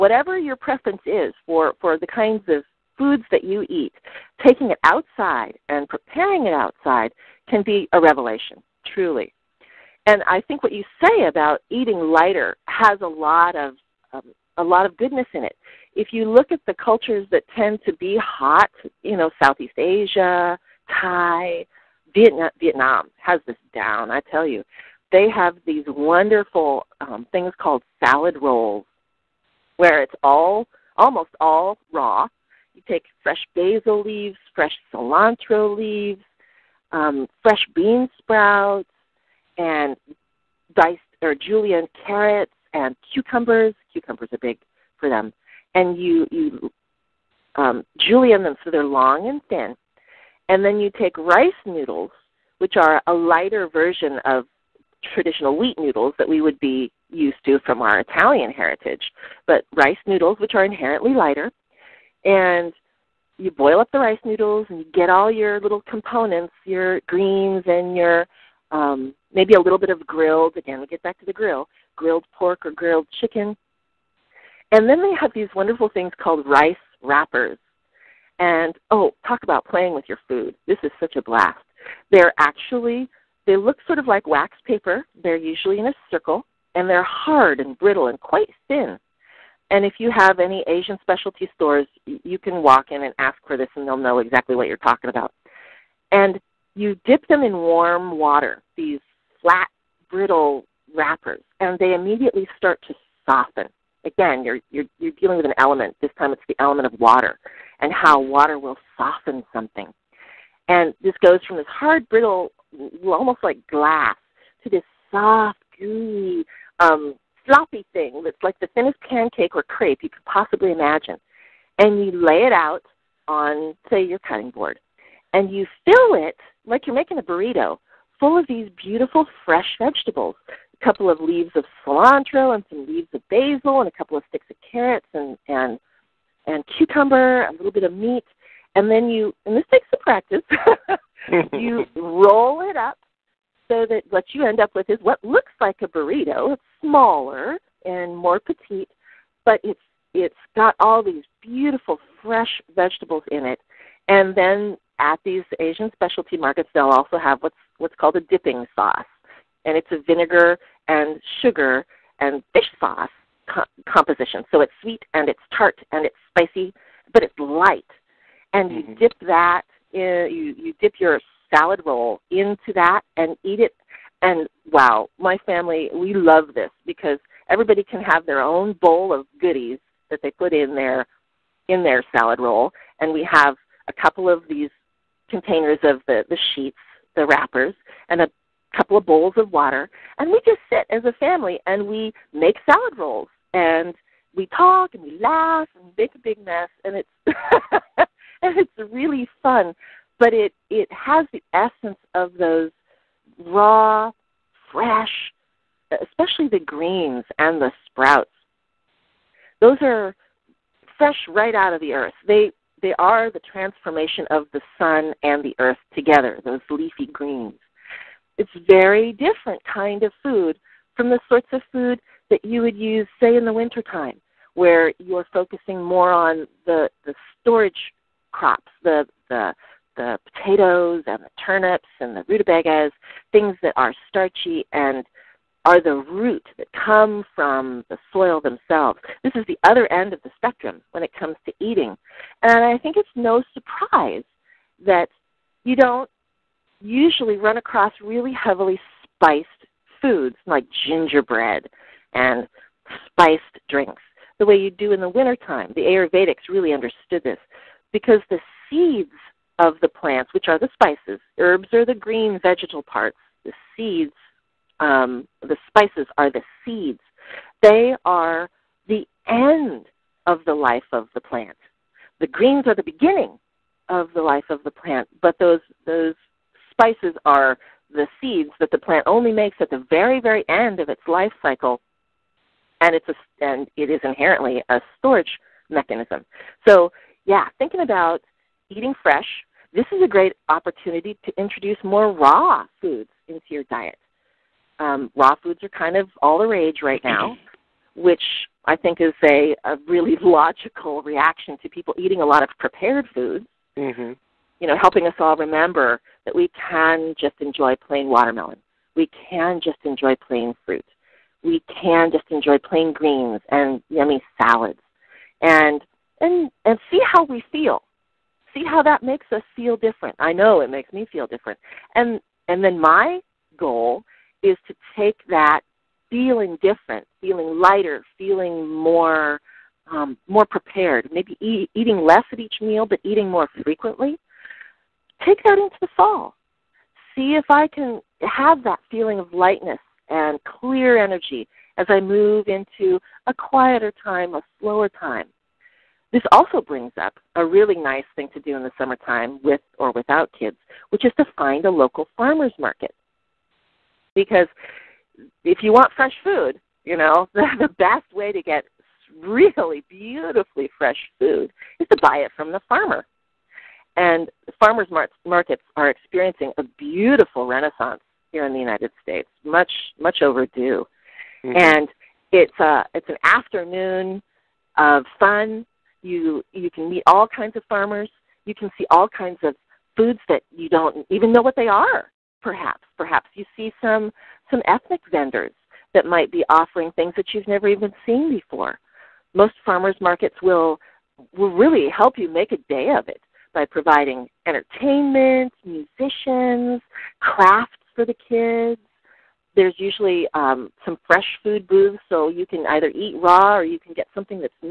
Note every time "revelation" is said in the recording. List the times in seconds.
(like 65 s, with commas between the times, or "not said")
7 s.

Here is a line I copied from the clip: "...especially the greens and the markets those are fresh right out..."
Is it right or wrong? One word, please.
wrong.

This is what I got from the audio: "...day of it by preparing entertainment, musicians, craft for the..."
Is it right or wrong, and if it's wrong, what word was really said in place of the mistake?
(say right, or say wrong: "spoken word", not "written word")
wrong: "providing", not "preparing".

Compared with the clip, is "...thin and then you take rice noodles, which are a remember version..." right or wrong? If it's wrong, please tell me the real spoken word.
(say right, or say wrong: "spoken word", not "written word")
wrong: "lighter", not "remember".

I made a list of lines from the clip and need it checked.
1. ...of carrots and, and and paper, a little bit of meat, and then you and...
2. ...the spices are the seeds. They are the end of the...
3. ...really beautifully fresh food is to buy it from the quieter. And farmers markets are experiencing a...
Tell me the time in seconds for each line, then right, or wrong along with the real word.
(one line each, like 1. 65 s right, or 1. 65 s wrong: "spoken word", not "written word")
1. 134 s wrong: "cucumber", not "paper"
2. 265 s right
3. 359 s wrong: "farmer", not "quieter".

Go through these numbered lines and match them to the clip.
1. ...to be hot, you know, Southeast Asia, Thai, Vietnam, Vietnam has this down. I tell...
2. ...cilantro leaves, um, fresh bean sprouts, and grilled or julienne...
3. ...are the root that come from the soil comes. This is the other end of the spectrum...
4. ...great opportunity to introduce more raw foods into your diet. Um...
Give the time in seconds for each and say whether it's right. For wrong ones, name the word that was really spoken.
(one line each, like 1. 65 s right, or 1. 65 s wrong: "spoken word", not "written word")
1. 17 s right
2. 34 s wrong: "diced", not "grilled"
3. 235 s wrong: "themselves", not "comes"
4. 290 s right.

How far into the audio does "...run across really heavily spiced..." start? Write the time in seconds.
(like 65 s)
247 s.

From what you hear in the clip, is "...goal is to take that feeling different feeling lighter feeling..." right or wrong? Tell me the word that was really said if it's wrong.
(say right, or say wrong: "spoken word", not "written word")
right.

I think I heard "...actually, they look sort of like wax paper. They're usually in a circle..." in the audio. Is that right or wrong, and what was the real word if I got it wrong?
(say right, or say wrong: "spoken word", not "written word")
right.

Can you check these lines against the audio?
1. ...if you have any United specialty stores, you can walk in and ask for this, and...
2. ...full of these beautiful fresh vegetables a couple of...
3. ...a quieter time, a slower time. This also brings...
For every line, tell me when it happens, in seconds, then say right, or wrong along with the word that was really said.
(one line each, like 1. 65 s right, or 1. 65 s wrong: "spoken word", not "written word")
1. 89 s wrong: "Asian", not "United"
2. 128 s right
3. 343 s right.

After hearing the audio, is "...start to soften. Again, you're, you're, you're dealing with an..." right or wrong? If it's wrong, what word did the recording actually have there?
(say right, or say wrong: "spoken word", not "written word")
right.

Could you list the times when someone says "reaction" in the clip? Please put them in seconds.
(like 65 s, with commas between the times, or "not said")
301 s.